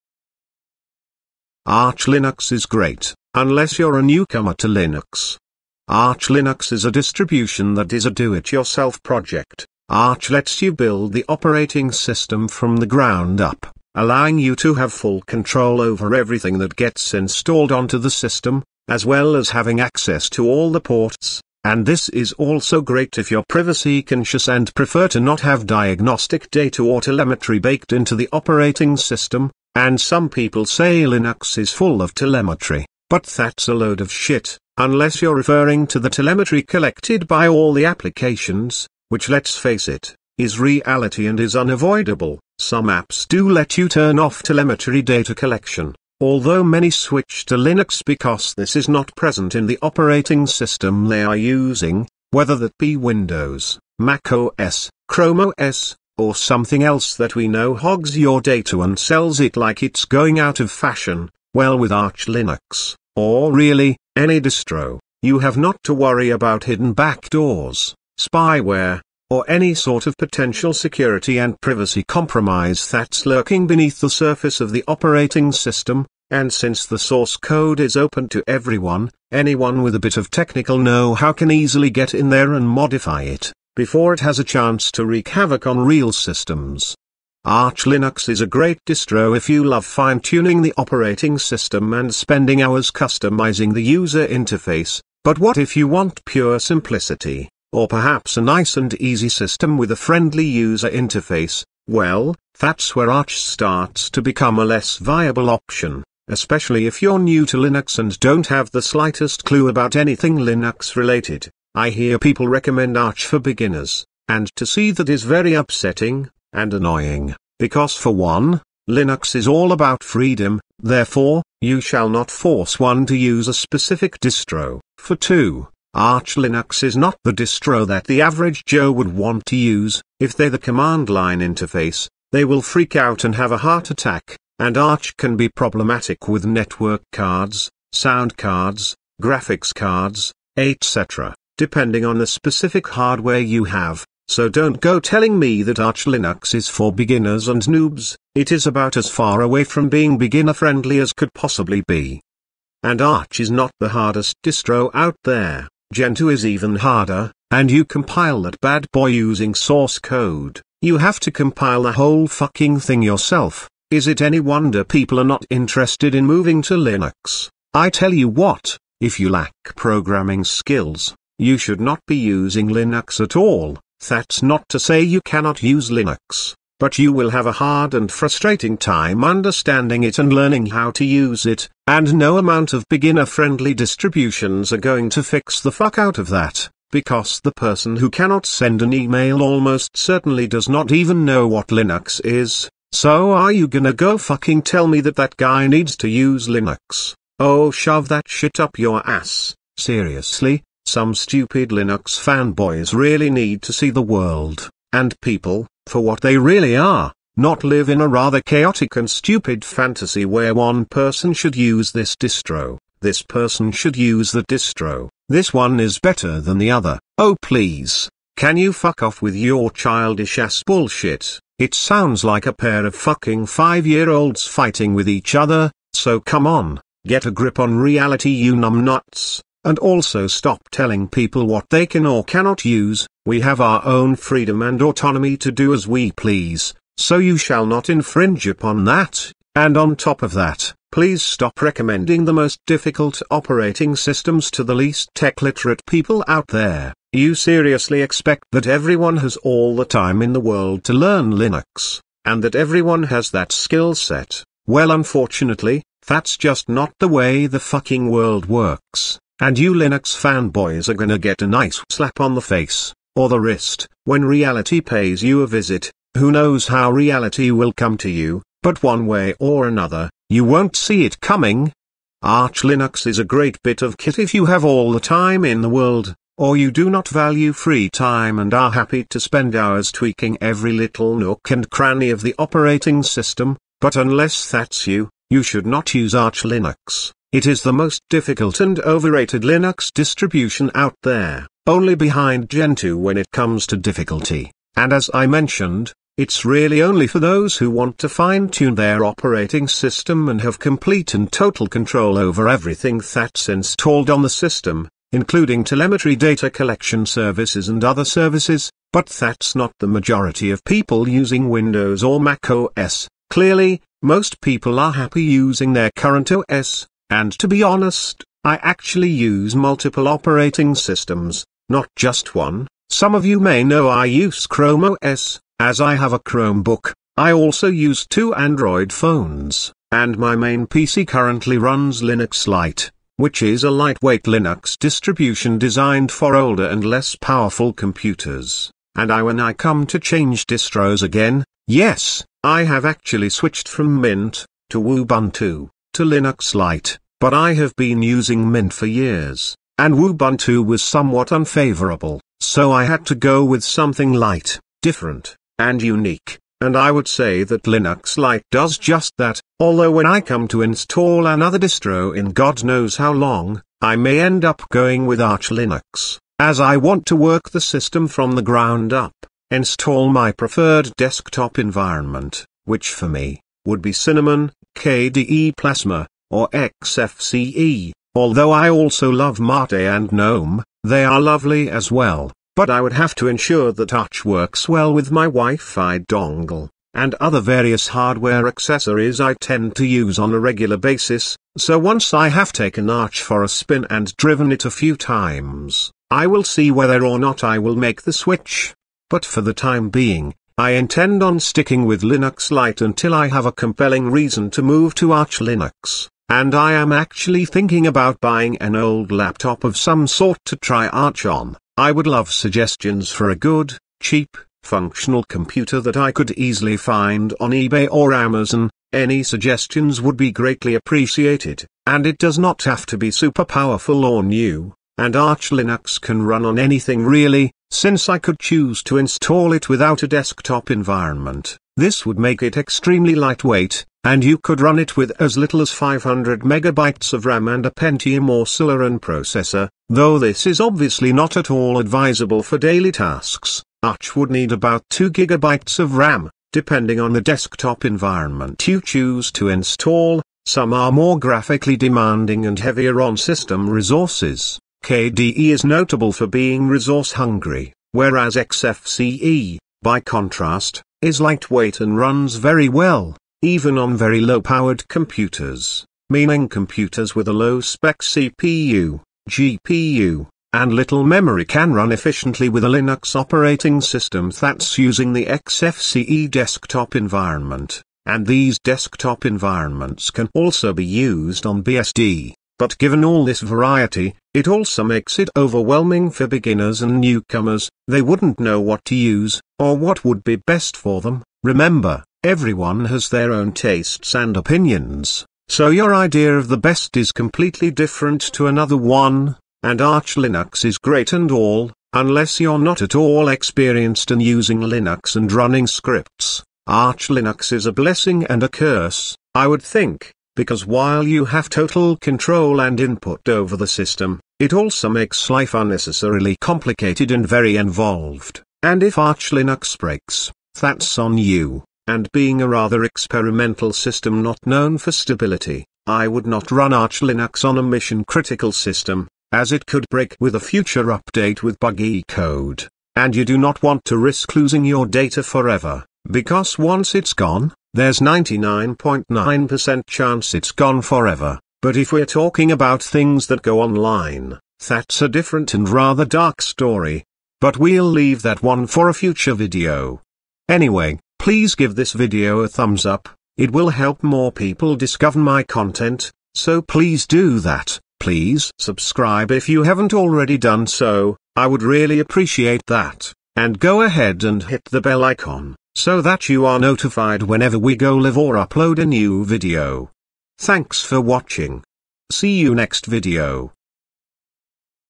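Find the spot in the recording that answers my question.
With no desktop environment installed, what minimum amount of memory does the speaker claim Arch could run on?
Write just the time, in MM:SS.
07:15.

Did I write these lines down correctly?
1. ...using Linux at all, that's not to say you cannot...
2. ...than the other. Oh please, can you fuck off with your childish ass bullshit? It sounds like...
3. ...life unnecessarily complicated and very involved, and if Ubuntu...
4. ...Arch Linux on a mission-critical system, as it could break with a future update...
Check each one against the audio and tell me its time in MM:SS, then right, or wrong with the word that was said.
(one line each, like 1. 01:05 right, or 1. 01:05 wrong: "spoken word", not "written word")
1. 02:52 right
2. 03:36 right
3. 08:35 wrong: "Arch", not "Ubuntu"
4. 08:46 right.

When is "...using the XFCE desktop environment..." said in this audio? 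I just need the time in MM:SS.
07:54.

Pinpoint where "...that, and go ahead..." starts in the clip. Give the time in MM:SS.
09:22.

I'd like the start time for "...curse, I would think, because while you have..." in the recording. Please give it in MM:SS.
08:28.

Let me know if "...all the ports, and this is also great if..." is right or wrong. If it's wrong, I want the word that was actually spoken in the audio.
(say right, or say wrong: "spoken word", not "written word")
right.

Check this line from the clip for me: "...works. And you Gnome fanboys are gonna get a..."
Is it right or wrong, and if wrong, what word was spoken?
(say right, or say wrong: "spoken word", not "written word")
wrong: "Linux", not "Gnome".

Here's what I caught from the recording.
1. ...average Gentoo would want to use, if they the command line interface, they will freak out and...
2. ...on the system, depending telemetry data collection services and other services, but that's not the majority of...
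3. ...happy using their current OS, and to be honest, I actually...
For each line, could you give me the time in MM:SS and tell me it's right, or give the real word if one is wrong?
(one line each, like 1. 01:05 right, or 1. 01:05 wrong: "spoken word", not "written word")
1. 02:08 wrong: "Joe", not "Gentoo"
2. 05:04 wrong: "including", not "depending"
3. 05:14 right.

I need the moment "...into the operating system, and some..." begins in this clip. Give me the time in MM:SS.
00:27.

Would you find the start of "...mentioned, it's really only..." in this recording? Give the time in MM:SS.
04:55.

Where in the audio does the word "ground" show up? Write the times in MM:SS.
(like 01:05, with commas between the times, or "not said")
00:12, 06:08.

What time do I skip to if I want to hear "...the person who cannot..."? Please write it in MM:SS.
03:07.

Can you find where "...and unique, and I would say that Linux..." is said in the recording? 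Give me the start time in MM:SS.
05:55.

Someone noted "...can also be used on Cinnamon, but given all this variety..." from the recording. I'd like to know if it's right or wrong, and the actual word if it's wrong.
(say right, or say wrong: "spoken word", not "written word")
wrong: "BSD", not "Cinnamon".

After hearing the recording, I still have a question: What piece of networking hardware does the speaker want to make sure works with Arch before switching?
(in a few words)
Wi-Fi dongle.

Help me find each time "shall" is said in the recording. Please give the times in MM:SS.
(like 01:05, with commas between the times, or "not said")
02:01, 03:57.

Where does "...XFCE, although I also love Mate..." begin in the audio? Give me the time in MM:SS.
06:16.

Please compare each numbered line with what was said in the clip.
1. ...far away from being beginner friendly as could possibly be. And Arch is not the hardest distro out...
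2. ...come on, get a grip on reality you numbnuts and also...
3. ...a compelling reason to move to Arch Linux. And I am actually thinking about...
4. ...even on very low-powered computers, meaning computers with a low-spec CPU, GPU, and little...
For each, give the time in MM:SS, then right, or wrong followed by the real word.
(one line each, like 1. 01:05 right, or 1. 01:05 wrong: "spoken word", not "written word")
1. 02:29 right
2. 03:46 right
3. 06:43 right
4. 07:43 right.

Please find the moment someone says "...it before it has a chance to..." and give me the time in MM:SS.
01:23.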